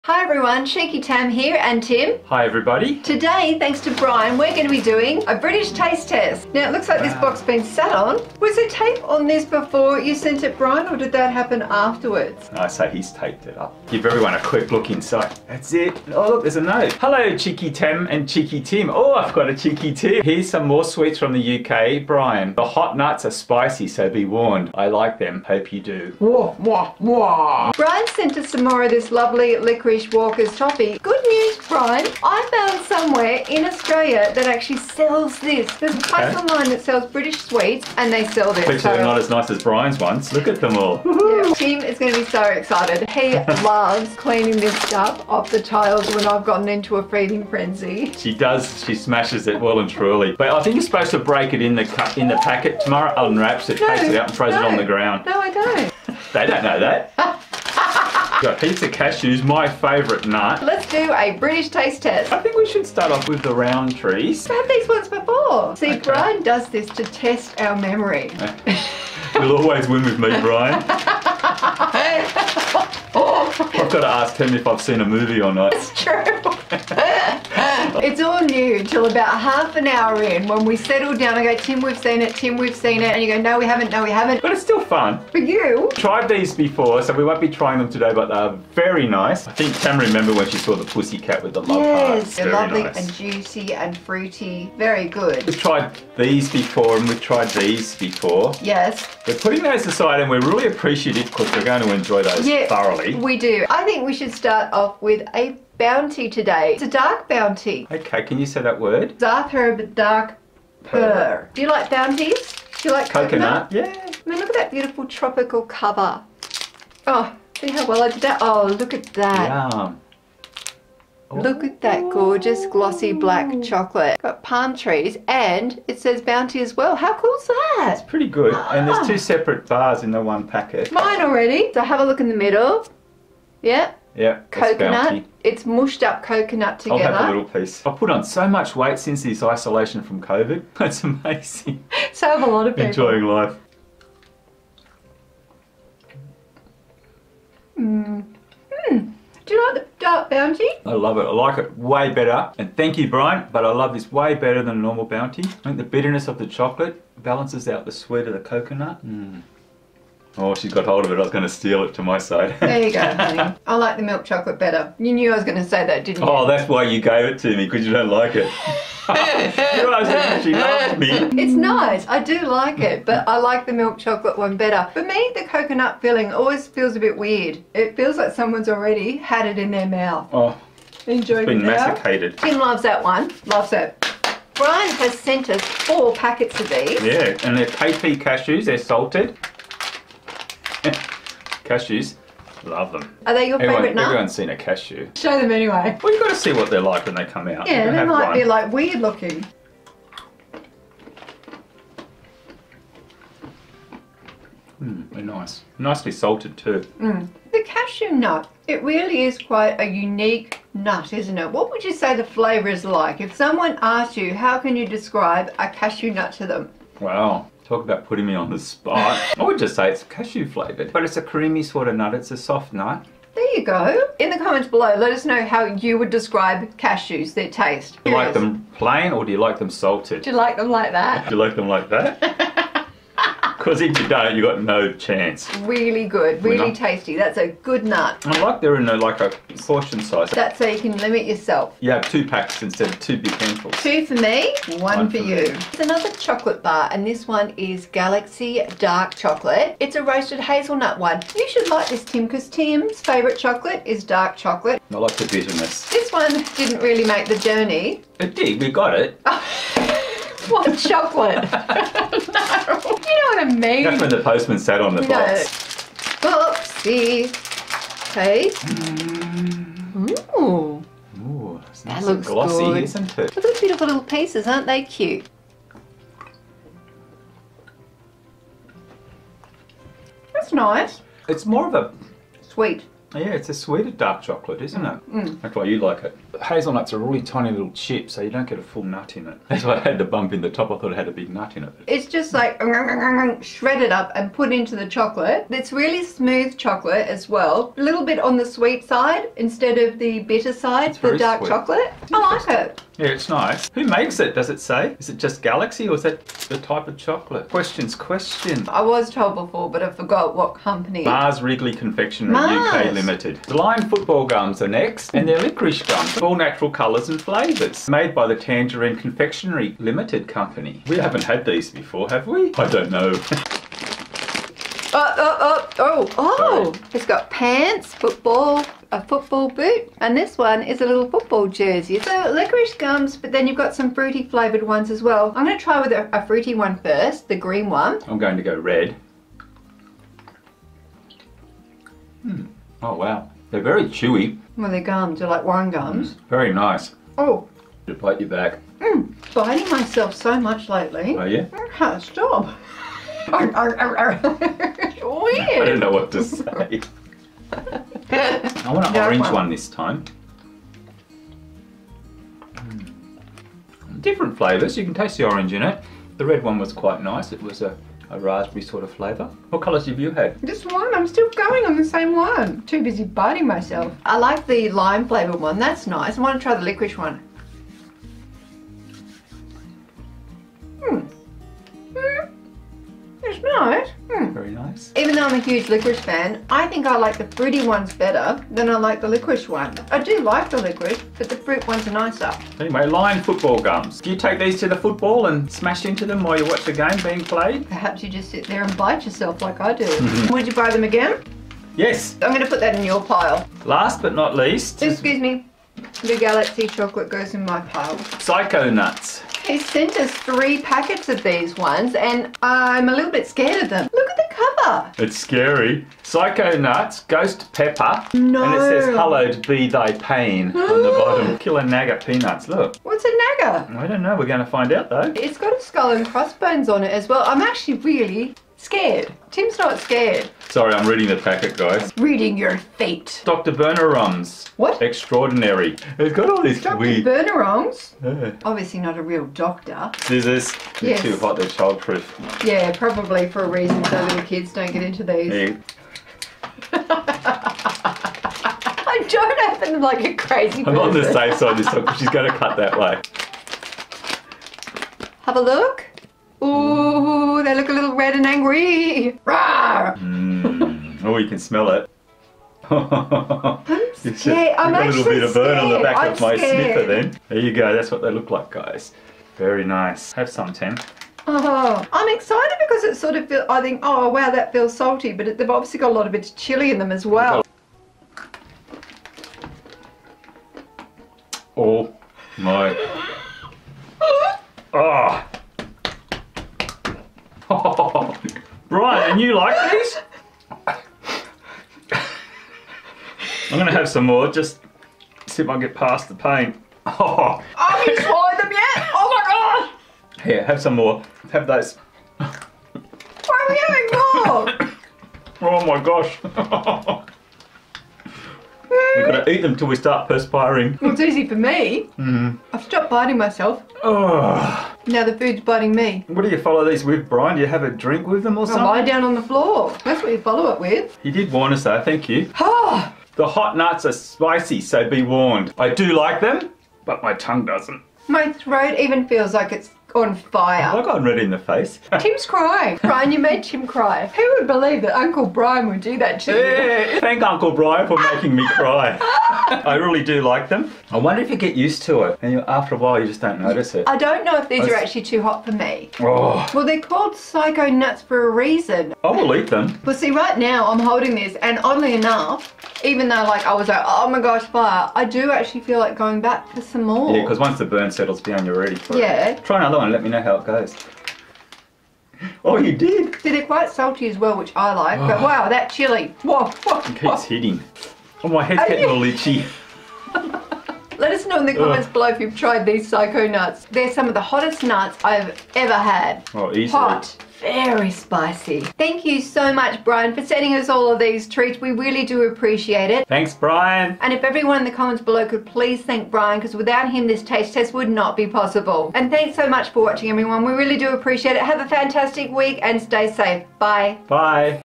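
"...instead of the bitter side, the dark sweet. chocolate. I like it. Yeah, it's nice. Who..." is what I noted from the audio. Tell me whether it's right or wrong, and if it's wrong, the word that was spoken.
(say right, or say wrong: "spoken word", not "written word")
right.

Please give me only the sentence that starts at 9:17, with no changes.
Yeah, because once the burn settles down, you're ready for yeah.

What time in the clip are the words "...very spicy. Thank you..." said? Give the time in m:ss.
9:37.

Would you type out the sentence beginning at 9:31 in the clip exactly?
below if you've tried these psycho nuts.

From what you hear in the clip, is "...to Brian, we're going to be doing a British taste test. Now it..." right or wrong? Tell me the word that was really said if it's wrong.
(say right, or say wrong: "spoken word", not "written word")
right.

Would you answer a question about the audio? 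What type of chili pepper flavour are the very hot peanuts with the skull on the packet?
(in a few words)
Ghost Pepper.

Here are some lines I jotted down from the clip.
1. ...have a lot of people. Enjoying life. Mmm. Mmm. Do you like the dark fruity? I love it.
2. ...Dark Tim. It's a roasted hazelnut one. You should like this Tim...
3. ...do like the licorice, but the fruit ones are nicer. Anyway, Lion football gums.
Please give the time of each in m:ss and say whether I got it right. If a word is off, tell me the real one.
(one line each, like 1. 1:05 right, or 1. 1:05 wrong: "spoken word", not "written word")
1. 2:22 wrong: "bounty", not "fruity"
2. 4:08 wrong: "Chocolate", not "Tim"
3. 6:29 right.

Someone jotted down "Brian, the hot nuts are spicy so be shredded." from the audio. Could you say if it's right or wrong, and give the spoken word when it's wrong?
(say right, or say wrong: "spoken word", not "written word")
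wrong: "warned", not "shredded".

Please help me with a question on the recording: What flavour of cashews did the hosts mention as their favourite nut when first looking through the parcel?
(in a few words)
Pizza.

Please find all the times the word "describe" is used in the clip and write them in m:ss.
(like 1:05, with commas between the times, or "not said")
3:34, 3:46.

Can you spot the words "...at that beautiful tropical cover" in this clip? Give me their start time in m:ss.
1:54.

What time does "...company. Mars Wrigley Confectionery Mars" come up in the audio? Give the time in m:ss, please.
5:10.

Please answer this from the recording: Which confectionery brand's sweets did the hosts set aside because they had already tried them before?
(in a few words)
Rowntree's.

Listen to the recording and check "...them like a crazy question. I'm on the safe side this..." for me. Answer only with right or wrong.
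wrong.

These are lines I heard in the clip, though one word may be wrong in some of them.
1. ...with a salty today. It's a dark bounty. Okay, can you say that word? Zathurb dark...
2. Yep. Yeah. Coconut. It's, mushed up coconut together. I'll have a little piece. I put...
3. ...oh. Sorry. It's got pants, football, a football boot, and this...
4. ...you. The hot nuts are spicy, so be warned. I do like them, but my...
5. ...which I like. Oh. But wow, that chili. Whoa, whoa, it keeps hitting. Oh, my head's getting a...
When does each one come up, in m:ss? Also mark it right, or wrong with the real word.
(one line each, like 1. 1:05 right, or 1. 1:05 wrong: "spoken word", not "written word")
1. 1:45 wrong: "bounty", not "salty"
2. 2:13 right
3. 5:26 right
4. 8:42 right
5. 9:24 right.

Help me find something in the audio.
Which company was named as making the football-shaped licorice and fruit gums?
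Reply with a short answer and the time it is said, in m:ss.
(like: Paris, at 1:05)
Tangerine Confectionery Limited, at 5:18.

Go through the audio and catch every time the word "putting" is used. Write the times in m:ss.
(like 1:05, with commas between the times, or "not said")
1:39, 3:38.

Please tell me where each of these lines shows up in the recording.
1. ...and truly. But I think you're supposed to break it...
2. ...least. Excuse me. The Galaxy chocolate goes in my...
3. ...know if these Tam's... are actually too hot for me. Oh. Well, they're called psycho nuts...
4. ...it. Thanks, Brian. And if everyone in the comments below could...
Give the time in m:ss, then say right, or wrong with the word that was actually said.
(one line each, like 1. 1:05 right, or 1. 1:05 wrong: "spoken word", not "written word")
1. 0:49 right
2. 6:44 right
3. 9:04 wrong: "That", not "Tam"
4. 9:42 right.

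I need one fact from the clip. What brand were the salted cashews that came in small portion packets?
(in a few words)
KP.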